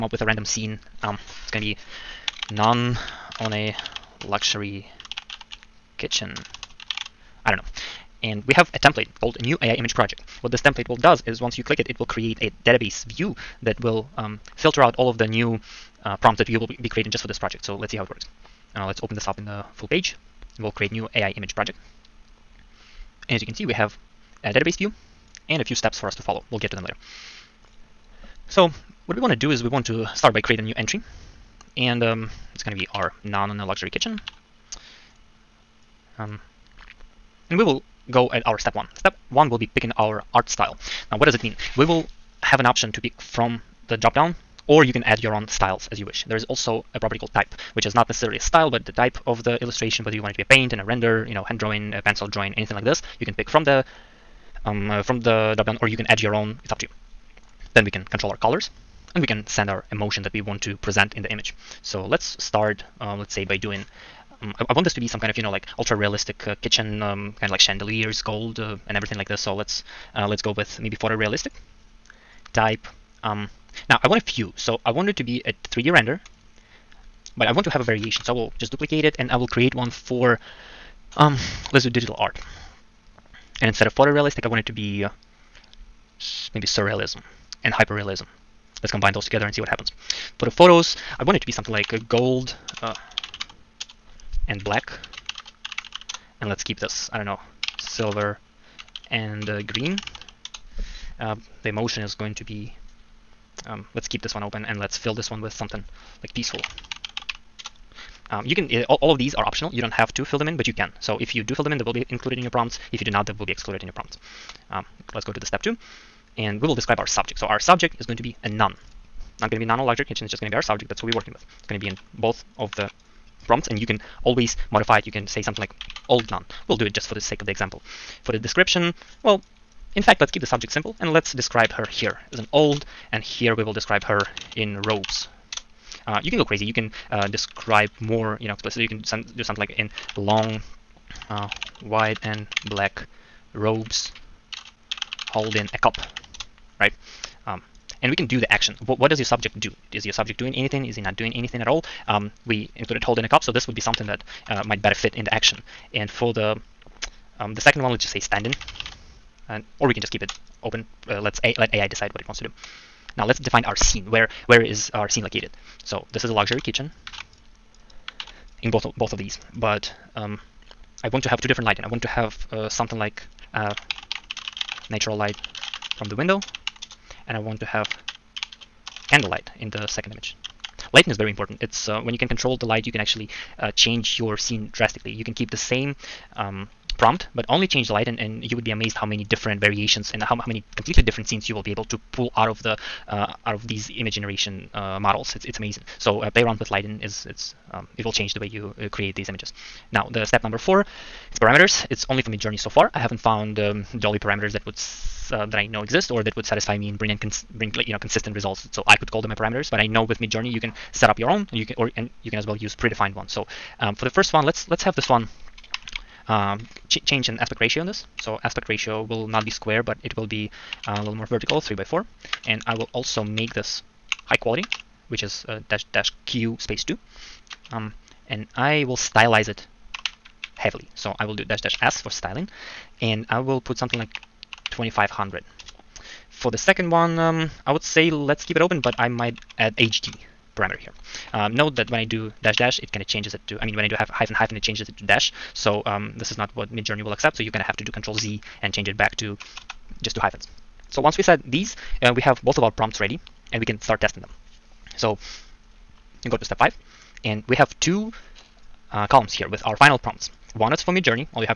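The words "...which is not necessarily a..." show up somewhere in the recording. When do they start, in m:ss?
0:47.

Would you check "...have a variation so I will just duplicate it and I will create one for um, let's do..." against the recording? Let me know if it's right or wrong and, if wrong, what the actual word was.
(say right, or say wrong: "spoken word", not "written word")
right.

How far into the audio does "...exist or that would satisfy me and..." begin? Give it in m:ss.
3:25.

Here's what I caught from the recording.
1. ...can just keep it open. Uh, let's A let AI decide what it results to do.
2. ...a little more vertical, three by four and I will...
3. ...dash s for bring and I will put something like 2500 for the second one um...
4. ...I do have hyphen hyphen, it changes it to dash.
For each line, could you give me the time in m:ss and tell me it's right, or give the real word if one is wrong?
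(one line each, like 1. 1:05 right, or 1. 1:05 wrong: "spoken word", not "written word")
1. 2:39 wrong: "wants", not "results"
2. 3:40 right
3. 3:51 wrong: "styling", not "bring"
4. 4:03 right.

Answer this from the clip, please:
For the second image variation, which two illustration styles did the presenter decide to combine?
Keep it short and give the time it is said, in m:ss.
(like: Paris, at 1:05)
Surrealism and hyperrealism, at 1:26.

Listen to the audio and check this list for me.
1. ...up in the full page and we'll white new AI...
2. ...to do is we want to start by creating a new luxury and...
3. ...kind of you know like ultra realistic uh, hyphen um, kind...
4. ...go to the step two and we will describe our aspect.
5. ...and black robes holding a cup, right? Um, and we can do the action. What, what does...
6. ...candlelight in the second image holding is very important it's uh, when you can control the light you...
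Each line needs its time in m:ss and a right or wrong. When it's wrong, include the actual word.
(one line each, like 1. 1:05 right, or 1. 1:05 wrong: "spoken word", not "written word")
1. 0:19 wrong: "create", not "white"
2. 0:29 wrong: "entry", not "luxury"
3. 1:05 wrong: "kitchen", not "hyphen"
4. 1:55 wrong: "subject", not "aspect"
5. 2:22 right
6. 2:59 wrong: "lighting", not "holding".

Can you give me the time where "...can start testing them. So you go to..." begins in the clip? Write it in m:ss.
4:13.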